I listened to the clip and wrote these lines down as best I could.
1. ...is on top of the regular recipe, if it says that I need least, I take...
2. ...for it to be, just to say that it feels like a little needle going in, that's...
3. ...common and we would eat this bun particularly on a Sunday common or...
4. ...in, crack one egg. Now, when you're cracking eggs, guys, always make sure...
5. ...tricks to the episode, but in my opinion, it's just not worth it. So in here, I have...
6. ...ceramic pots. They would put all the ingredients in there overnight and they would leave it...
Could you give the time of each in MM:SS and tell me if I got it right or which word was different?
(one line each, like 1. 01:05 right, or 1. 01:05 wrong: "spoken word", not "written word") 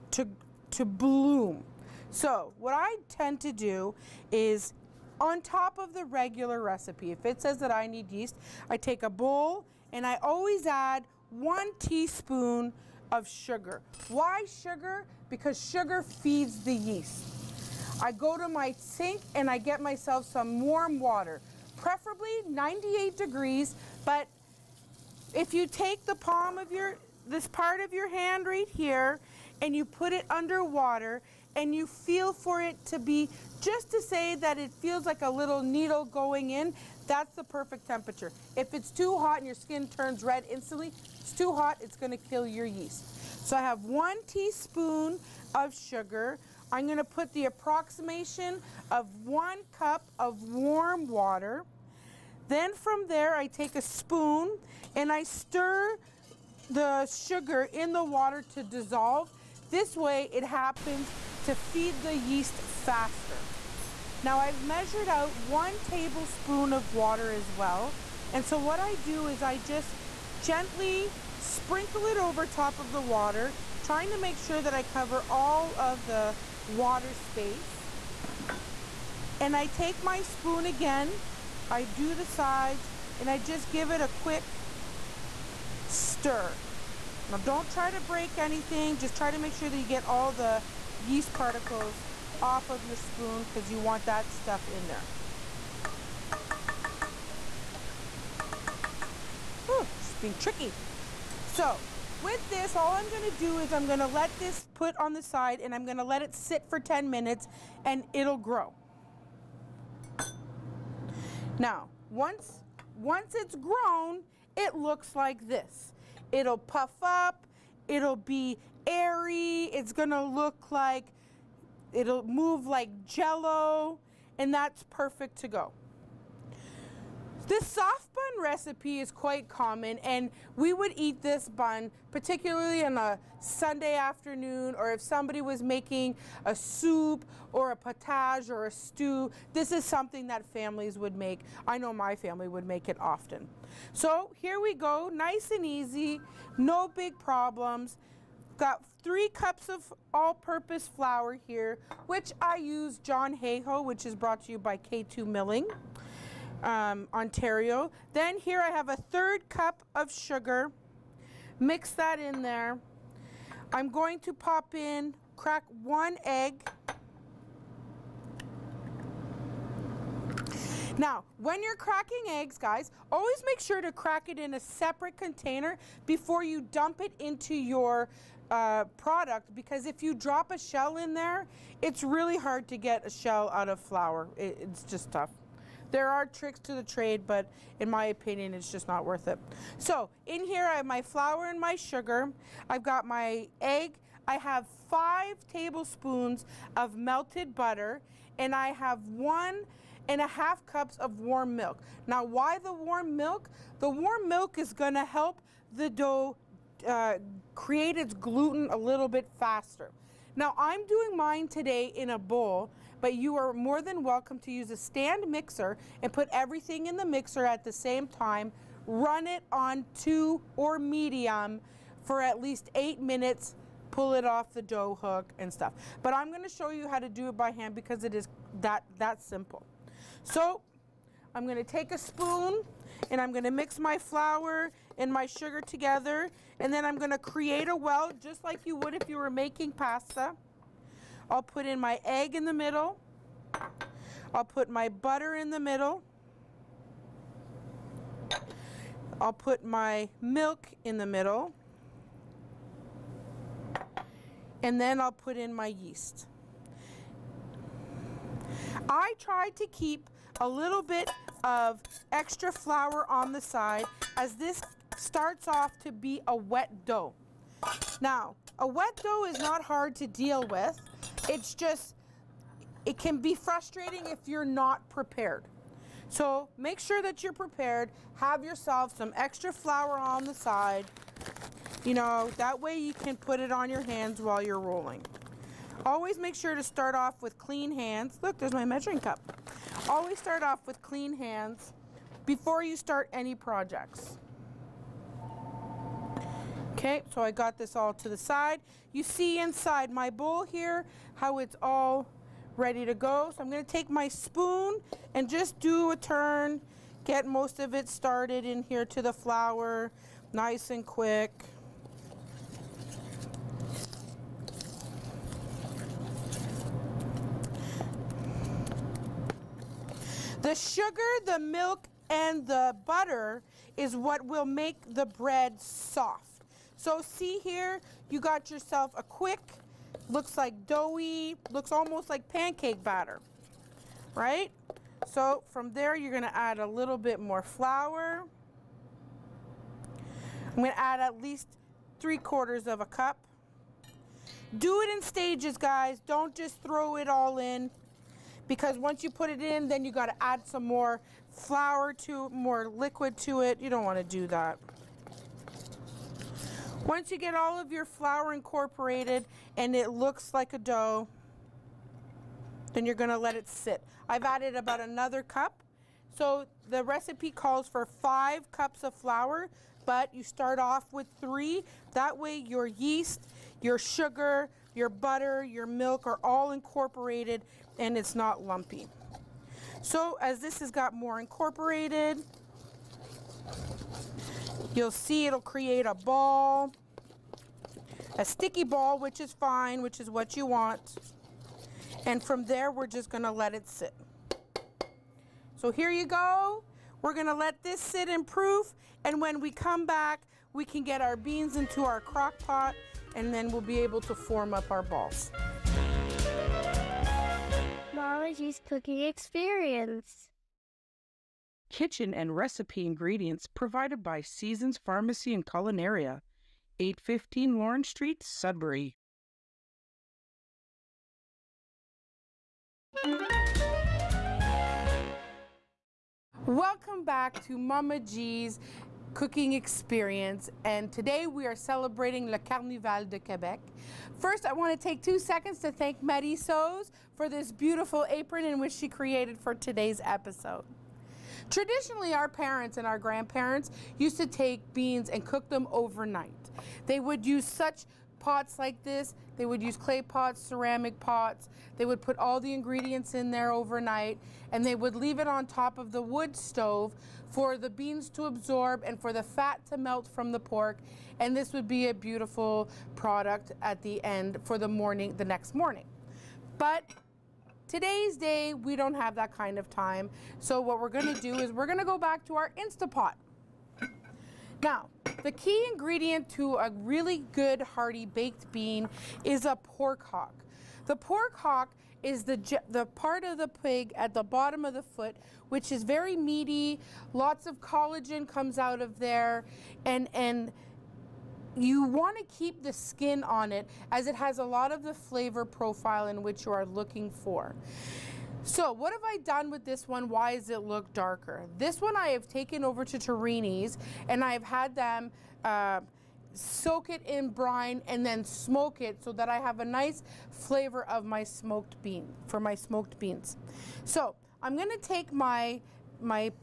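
1. 00:04 wrong: "yeast", not "least"
2. 00:32 right
3. 02:09 wrong: "afternoon", not "common"
4. 02:44 right
5. 03:06 wrong: "trade", not "episode"
6. 07:30 right.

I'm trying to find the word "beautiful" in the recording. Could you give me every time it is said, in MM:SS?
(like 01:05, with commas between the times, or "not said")
07:17, 07:41.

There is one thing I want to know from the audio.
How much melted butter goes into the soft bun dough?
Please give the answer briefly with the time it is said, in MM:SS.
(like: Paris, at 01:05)
5 tablespoons, at 03:14.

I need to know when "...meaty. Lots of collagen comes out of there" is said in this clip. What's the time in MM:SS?
08:06.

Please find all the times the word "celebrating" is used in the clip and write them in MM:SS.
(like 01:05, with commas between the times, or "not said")
07:11.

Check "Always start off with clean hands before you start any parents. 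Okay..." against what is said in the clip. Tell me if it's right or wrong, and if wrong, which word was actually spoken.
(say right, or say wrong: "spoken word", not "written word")
wrong: "projects", not "parents".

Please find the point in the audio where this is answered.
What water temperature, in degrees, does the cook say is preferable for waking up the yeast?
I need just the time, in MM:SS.
00:22.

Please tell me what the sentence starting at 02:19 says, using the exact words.
This is something that families would make.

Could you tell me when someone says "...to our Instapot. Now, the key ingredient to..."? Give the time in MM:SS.
07:52.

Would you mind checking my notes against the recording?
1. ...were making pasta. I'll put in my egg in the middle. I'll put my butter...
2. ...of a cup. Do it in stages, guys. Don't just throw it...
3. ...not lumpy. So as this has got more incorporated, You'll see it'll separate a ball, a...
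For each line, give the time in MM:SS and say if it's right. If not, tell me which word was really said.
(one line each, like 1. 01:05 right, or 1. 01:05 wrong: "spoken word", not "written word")
1. 03:59 right
2. 05:42 right
3. 06:18 wrong: "create", not "separate".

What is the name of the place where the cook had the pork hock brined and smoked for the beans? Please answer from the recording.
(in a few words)
Torini's.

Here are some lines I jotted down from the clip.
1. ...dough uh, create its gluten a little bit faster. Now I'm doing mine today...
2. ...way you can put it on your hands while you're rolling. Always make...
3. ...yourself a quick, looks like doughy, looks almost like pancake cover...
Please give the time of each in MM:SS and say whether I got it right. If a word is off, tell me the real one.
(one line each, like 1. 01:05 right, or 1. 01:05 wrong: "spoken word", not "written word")
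1. 03:25 right
2. 04:42 right
3. 05:28 wrong: "batter", not "cover".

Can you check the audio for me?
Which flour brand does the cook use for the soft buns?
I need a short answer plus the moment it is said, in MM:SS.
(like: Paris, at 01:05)
John Hayhoe, at 02:32.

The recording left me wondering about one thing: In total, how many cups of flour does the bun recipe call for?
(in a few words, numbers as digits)
5 cups.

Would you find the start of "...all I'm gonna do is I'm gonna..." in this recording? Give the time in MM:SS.
01:42.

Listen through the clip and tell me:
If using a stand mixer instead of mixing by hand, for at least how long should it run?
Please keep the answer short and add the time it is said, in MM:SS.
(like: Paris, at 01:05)
8 minutes, at 03:42.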